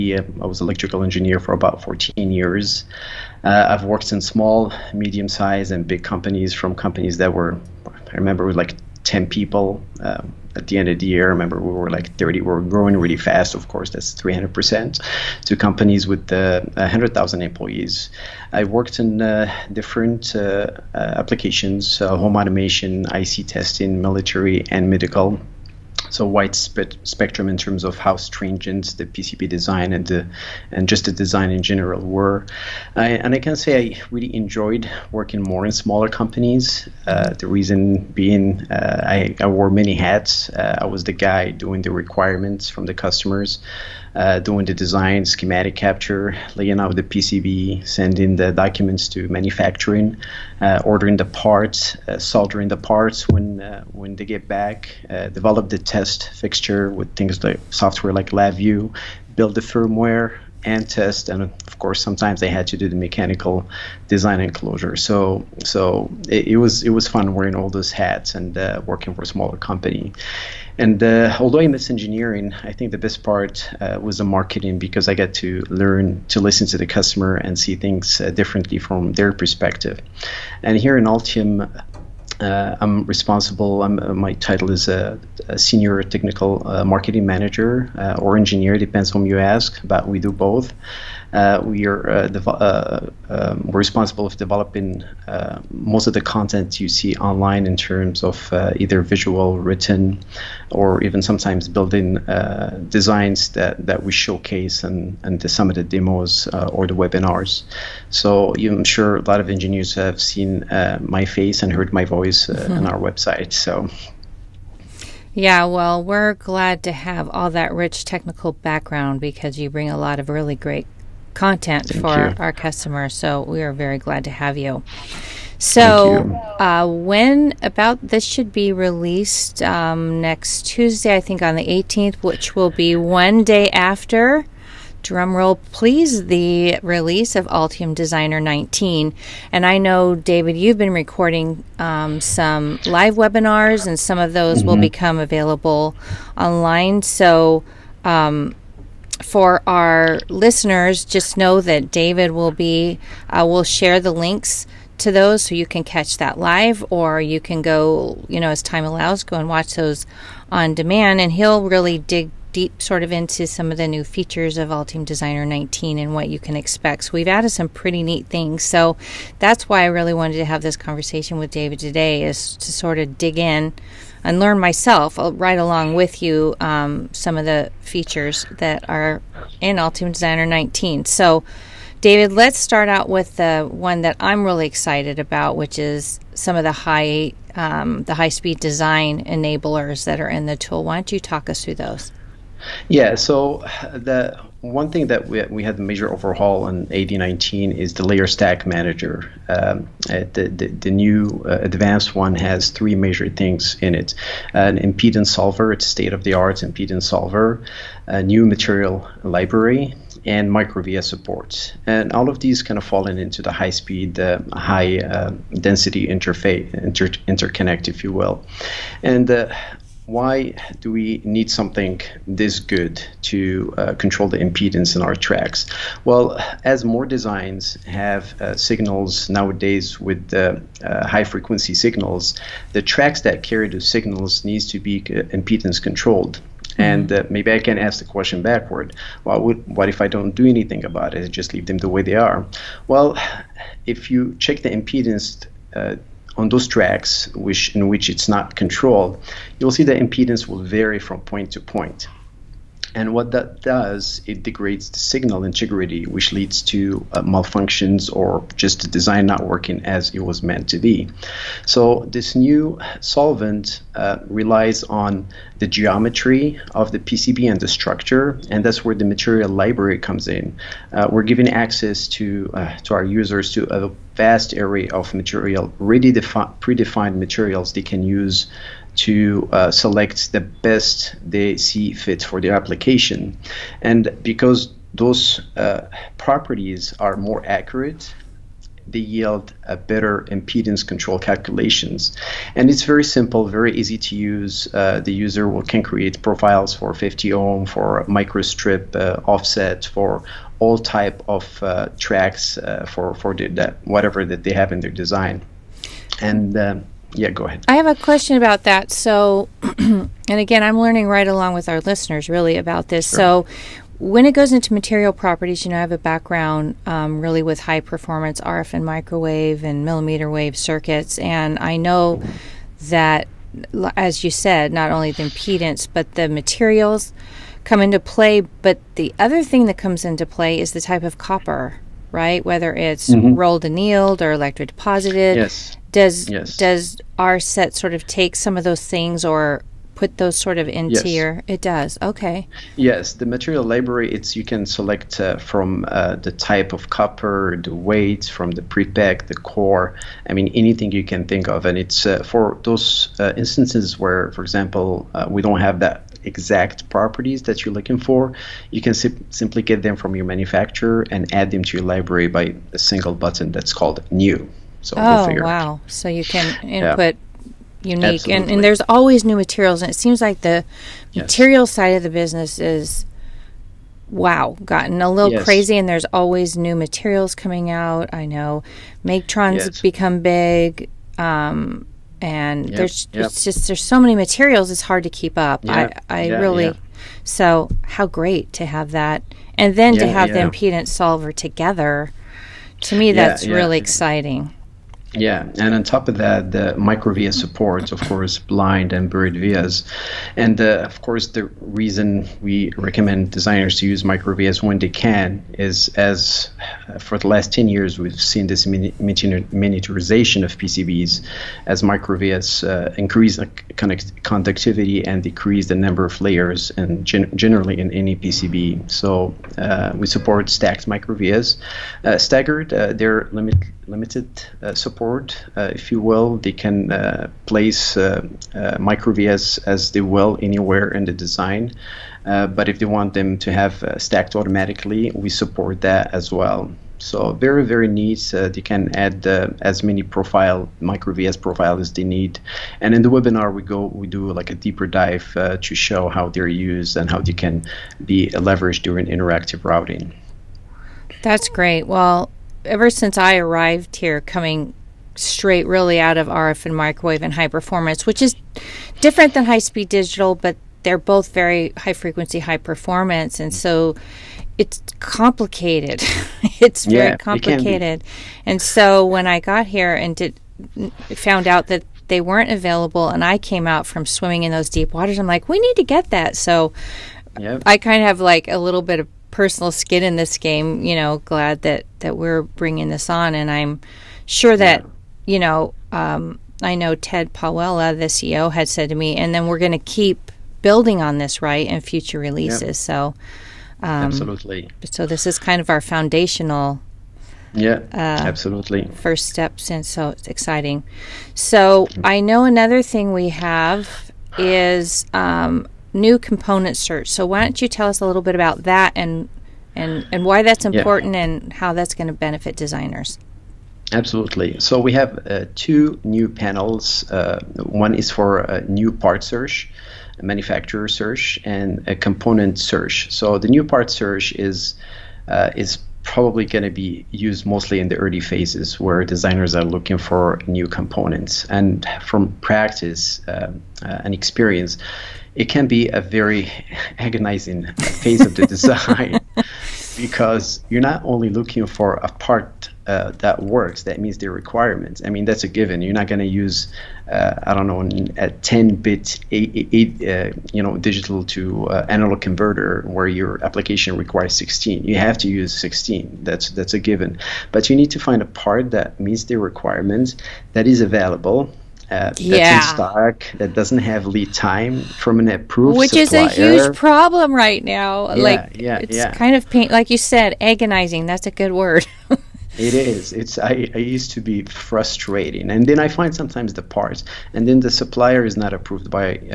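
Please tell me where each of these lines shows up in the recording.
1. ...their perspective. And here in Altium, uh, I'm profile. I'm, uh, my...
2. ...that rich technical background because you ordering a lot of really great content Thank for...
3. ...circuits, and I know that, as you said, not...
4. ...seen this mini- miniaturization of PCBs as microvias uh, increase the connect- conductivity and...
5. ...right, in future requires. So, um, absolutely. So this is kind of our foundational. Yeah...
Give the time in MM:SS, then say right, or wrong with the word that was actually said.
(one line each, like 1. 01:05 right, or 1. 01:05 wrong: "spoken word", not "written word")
1. 01:19 wrong: "responsible", not "profile"
2. 01:57 wrong: "bring", not "ordering"
3. 05:20 right
4. 06:48 right
5. 08:11 wrong: "releases", not "requires".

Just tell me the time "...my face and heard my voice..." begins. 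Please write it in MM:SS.
01:51.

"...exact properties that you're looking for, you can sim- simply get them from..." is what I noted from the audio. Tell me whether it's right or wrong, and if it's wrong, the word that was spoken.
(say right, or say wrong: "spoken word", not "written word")
right.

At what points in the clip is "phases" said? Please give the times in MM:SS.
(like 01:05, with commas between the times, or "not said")
08:48, 08:57.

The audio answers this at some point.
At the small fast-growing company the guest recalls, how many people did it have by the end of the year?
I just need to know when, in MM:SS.
00:12.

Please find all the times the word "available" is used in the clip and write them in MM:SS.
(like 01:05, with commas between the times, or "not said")
02:25, 07:52, 09:20.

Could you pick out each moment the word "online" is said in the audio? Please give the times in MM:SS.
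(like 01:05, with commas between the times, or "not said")
01:37, 02:26.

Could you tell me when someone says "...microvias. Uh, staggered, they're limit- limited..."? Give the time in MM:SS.
07:00.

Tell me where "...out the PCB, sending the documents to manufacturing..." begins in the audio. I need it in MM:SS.
00:46.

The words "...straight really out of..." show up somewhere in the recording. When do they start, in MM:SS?
07:35.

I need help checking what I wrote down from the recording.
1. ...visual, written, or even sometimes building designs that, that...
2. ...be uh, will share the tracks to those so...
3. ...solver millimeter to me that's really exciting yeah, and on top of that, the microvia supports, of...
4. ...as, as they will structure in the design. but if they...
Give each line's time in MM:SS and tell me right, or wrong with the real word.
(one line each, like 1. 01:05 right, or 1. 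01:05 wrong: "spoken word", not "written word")
1. 01:39 right
2. 02:32 wrong: "links", not "tracks"
3. 06:30 wrong: "together", not "millimeter"
4. 07:09 wrong: "anywhere", not "structure".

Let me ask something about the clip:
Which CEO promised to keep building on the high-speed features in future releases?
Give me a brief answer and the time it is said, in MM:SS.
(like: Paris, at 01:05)
Ted Pawela, at 08:06.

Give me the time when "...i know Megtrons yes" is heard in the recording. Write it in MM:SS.
06:18.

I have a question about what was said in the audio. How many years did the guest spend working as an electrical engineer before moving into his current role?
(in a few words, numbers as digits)
14.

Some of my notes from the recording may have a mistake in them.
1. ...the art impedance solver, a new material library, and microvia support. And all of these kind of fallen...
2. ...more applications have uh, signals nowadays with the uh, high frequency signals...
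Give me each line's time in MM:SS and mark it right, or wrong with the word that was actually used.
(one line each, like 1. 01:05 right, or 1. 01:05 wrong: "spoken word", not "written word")
1. 03:26 right
2. 03:46 wrong: "designs", not "applications".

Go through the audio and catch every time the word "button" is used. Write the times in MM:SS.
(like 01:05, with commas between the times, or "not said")
06:03.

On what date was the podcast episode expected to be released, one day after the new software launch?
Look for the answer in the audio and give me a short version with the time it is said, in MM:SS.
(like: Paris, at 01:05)
the 18th, at 02:11.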